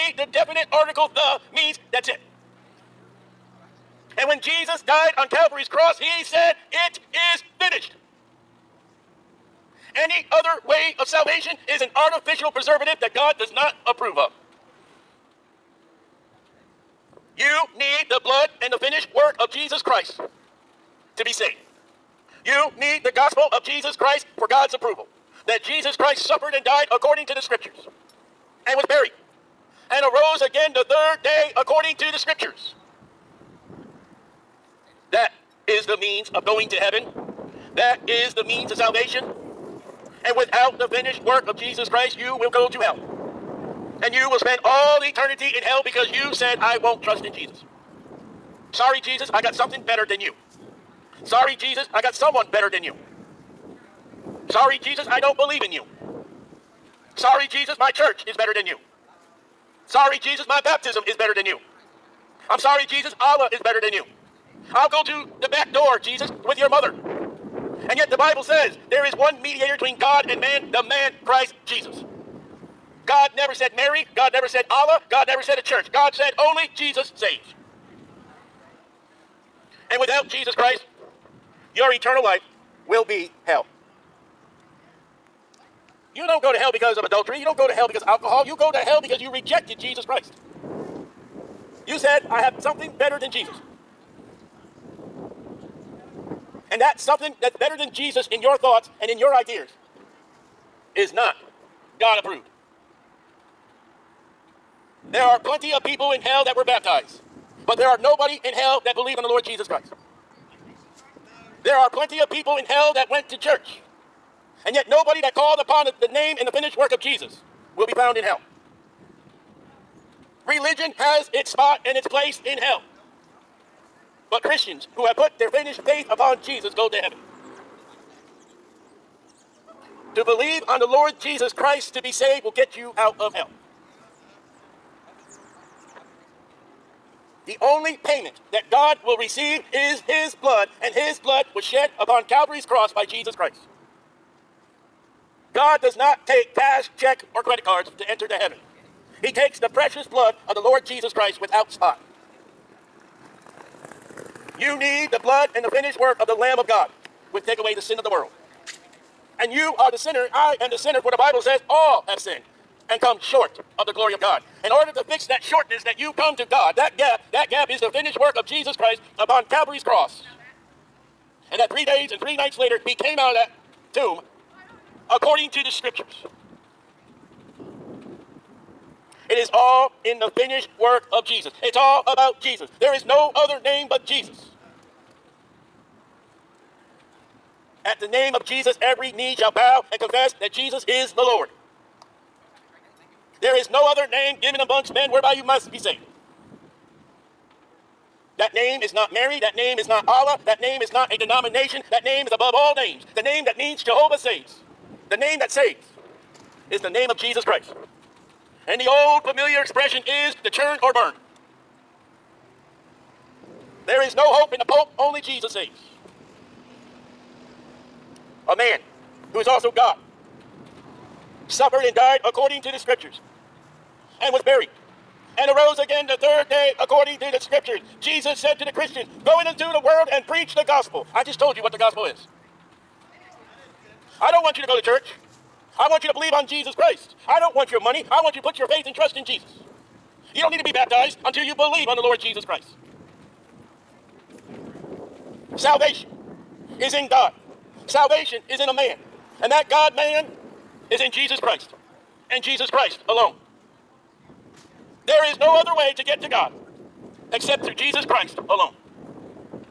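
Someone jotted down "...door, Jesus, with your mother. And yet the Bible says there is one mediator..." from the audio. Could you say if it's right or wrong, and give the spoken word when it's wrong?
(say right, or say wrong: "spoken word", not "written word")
right.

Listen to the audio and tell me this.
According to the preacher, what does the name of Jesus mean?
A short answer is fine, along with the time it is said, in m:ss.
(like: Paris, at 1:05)
Jehovah saves, at 3:23.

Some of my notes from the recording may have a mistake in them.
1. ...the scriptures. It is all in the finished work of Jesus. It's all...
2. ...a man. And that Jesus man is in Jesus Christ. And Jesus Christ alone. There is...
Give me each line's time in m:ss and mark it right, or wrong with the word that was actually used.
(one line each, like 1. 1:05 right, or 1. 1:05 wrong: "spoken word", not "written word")
1. 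2:55 right
2. 4:08 wrong: "God", not "Jesus".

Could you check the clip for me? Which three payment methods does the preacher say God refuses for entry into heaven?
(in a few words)
cash, check, or credit cards.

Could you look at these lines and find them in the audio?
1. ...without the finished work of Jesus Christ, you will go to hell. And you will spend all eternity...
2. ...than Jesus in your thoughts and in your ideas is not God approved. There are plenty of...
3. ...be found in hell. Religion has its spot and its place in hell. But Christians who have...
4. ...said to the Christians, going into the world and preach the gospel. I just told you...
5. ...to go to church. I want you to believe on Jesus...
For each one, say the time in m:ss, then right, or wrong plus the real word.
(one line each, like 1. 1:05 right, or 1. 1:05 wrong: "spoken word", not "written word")
1. 0:40 right
2. 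1:37 right
3. 1:57 right
4. 3:48 right
5. 3:54 right.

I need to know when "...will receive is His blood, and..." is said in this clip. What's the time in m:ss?
2:19.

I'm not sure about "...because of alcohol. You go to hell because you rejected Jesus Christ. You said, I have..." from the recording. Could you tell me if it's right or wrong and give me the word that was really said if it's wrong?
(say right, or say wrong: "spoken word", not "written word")
right.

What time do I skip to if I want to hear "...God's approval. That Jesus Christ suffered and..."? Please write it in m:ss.
0:24.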